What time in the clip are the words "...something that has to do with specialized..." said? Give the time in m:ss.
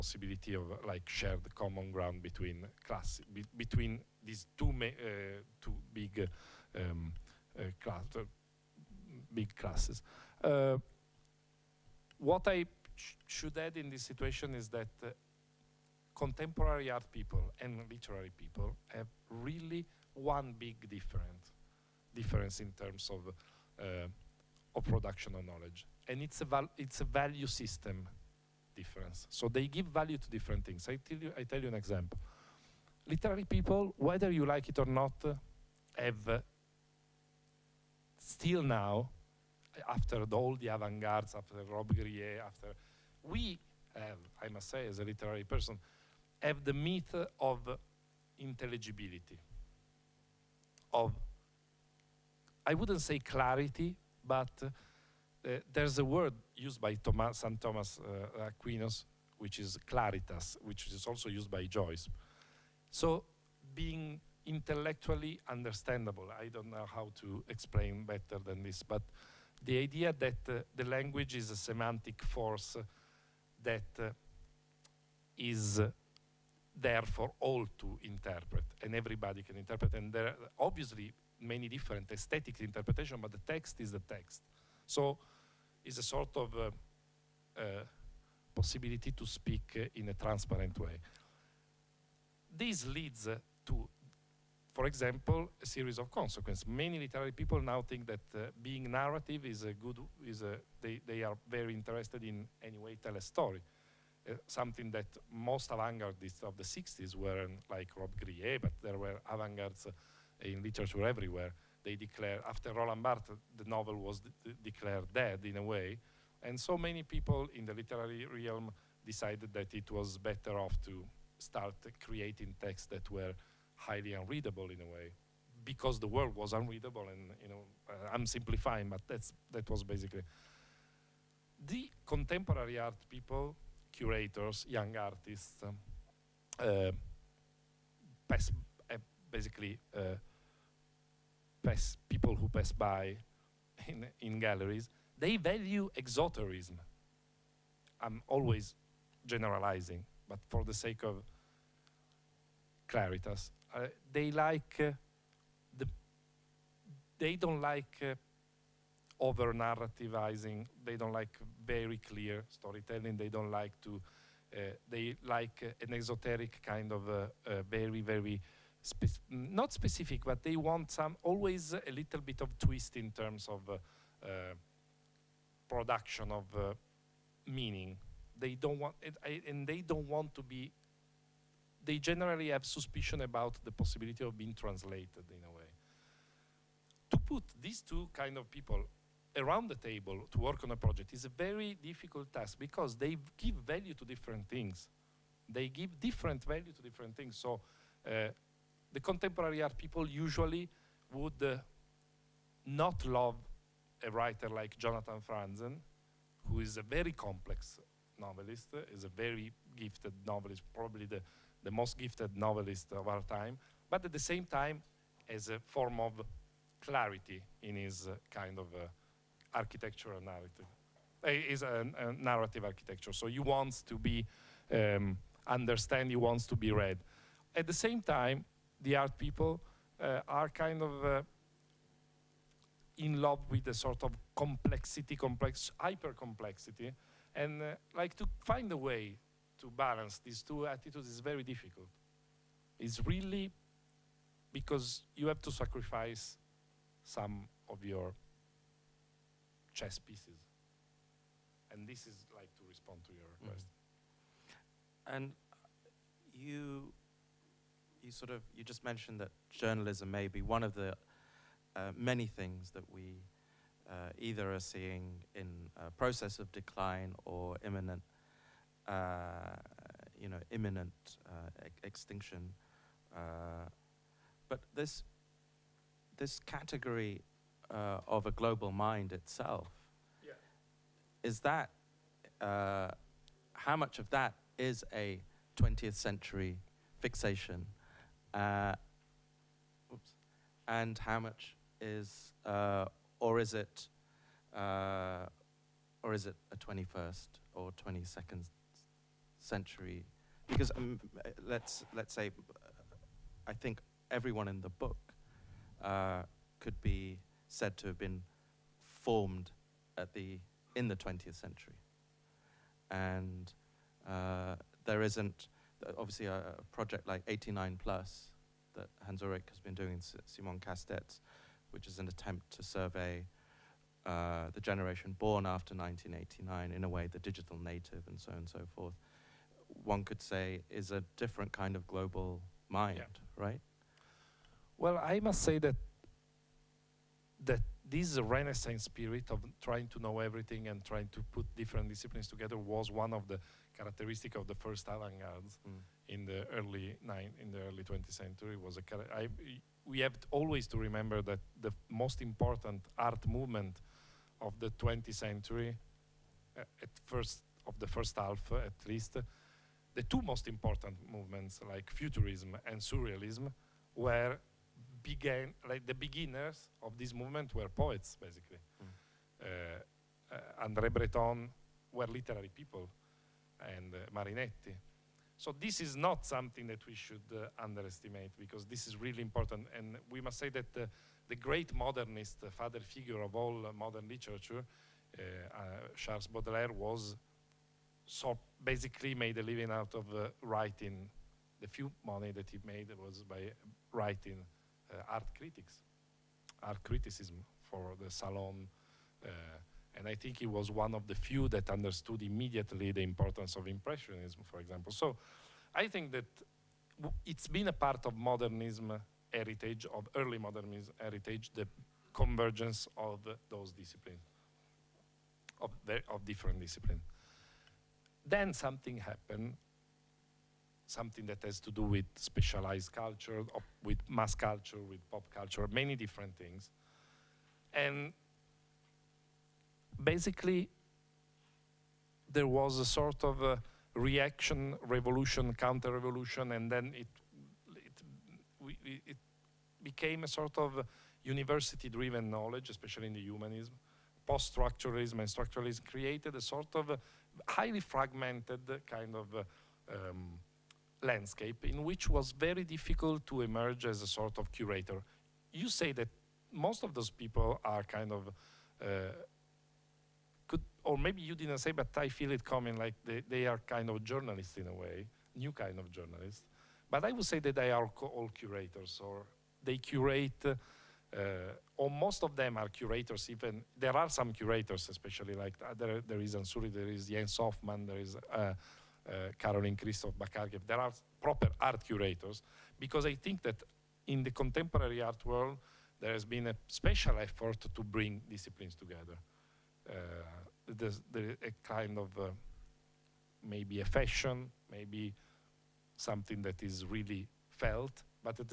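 7:00.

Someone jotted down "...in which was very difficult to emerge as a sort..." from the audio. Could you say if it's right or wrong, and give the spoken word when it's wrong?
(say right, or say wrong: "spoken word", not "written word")
right.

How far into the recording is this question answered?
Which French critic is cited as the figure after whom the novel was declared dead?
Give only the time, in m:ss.
1:52.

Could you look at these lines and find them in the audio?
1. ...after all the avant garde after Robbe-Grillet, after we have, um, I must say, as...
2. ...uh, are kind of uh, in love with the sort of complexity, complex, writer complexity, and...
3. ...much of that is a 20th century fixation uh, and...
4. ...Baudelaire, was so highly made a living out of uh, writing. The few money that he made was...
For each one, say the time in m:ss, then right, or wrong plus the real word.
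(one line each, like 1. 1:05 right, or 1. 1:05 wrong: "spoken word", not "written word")
1. 0:39 right
2. 3:50 wrong: "hyper", not "writer"
3. 4:43 right
4. 6:26 wrong: "basically", not "highly".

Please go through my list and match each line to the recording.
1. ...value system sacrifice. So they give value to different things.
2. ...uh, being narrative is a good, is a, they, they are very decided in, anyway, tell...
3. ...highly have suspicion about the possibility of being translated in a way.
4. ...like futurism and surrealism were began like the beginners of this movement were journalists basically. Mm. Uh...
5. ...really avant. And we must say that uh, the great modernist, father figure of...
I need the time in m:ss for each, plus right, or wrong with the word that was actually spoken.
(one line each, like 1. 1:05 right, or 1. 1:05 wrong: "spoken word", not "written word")
1. 0:27 wrong: "difference", not "sacrifice"
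2. 1:38 wrong: "interested", not "decided"
3. 3:01 wrong: "generally", not "highly"
4. 6:01 wrong: "poets", not "journalists"
5. 6:18 wrong: "important", not "avant".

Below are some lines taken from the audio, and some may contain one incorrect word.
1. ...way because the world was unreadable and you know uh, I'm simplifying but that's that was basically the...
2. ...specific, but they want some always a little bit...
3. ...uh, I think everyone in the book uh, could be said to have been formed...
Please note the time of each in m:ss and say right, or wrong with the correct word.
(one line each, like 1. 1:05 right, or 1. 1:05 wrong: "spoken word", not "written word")
1. 2:04 right
2. 2:49 right
3. 5:02 right.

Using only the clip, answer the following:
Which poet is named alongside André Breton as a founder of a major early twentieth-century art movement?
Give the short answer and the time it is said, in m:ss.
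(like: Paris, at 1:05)
Marinetti, at 6:14.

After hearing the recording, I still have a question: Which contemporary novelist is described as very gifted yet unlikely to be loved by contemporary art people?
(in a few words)
Jonathan Franzen.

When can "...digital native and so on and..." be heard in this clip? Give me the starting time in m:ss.
5:27.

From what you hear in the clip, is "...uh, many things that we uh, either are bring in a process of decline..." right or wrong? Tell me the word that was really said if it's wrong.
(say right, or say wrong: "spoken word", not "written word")
wrong: "seeing", not "bring".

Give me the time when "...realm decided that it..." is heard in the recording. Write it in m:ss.
1:58.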